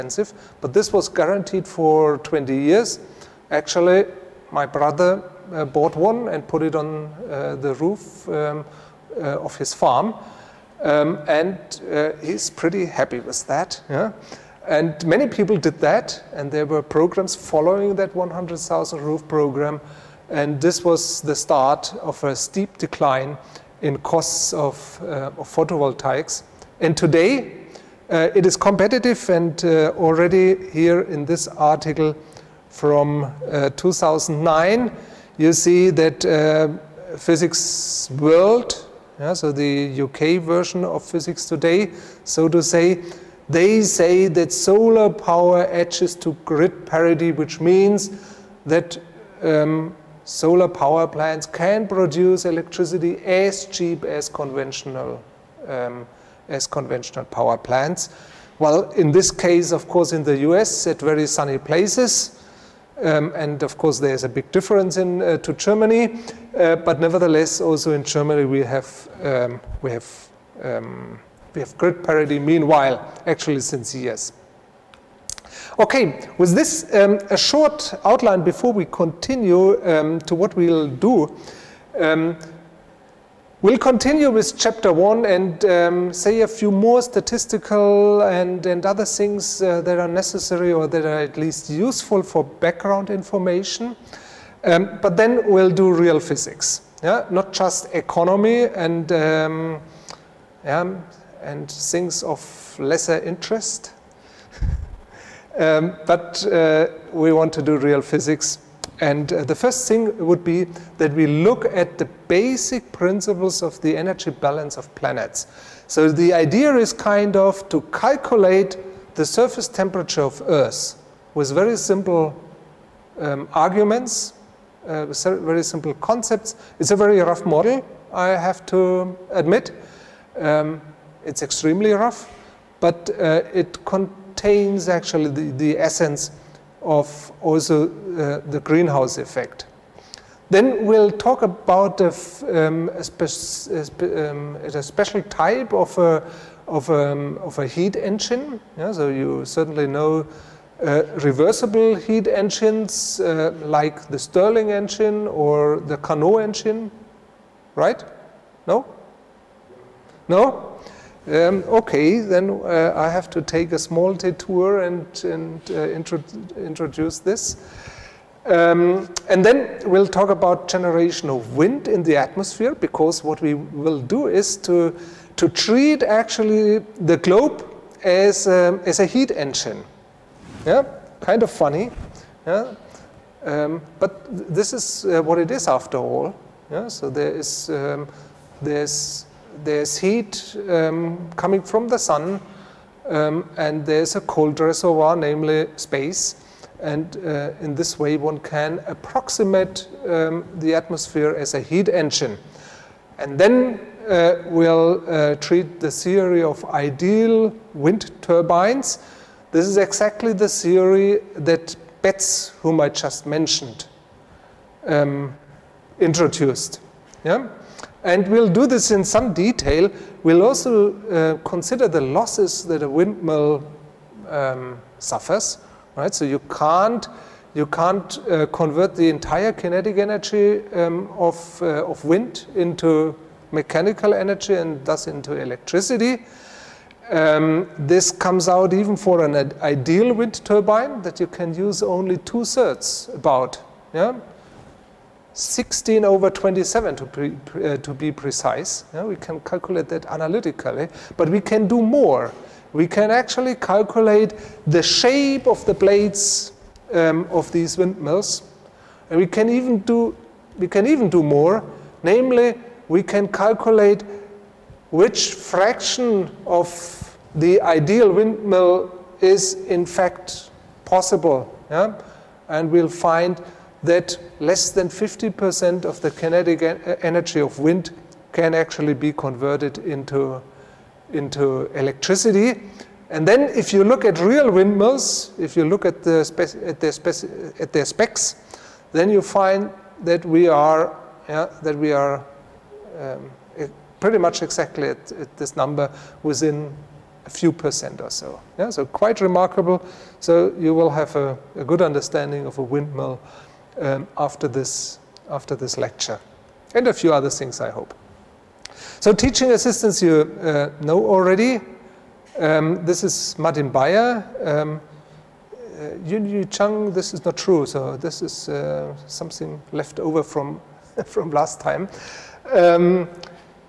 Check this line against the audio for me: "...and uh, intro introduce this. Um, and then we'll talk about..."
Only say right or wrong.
right.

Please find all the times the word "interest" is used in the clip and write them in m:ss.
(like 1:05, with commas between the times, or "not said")
1:43.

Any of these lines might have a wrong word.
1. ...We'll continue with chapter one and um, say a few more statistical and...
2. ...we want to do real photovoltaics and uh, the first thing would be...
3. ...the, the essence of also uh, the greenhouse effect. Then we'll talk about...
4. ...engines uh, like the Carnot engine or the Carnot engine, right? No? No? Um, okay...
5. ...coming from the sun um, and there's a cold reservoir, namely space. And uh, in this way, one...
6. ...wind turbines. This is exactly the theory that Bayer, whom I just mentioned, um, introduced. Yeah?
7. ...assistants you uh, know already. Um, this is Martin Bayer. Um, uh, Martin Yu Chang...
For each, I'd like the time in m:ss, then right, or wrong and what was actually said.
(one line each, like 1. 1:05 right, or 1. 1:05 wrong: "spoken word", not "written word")
1. 1:23 right
2. 1:47 wrong: "physics", not "photovoltaics"
3. 2:15 right
4. 2:32 wrong: "Stirling", not "Carnot"
5. 3:11 right
6. 3:27 wrong: "Betz", not "Bayer"
7. 5:09 wrong: "Yun", not "Martin".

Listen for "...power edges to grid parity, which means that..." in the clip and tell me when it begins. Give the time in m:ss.
0:45.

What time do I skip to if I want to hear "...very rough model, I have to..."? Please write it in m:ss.
2:06.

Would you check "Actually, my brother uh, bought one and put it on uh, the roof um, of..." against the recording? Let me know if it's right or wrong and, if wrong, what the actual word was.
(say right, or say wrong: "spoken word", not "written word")
right.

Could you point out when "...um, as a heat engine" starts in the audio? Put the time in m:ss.
2:58.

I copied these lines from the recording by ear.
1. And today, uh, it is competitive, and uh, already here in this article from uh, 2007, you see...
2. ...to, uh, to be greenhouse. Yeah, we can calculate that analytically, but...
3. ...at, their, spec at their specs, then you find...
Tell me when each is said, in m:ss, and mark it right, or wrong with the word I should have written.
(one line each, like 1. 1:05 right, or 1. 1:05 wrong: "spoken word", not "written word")
1. 0:26 wrong: "2009", not "2007"
2. 4:06 wrong: "precise", not "greenhouse"
3. 4:46 right.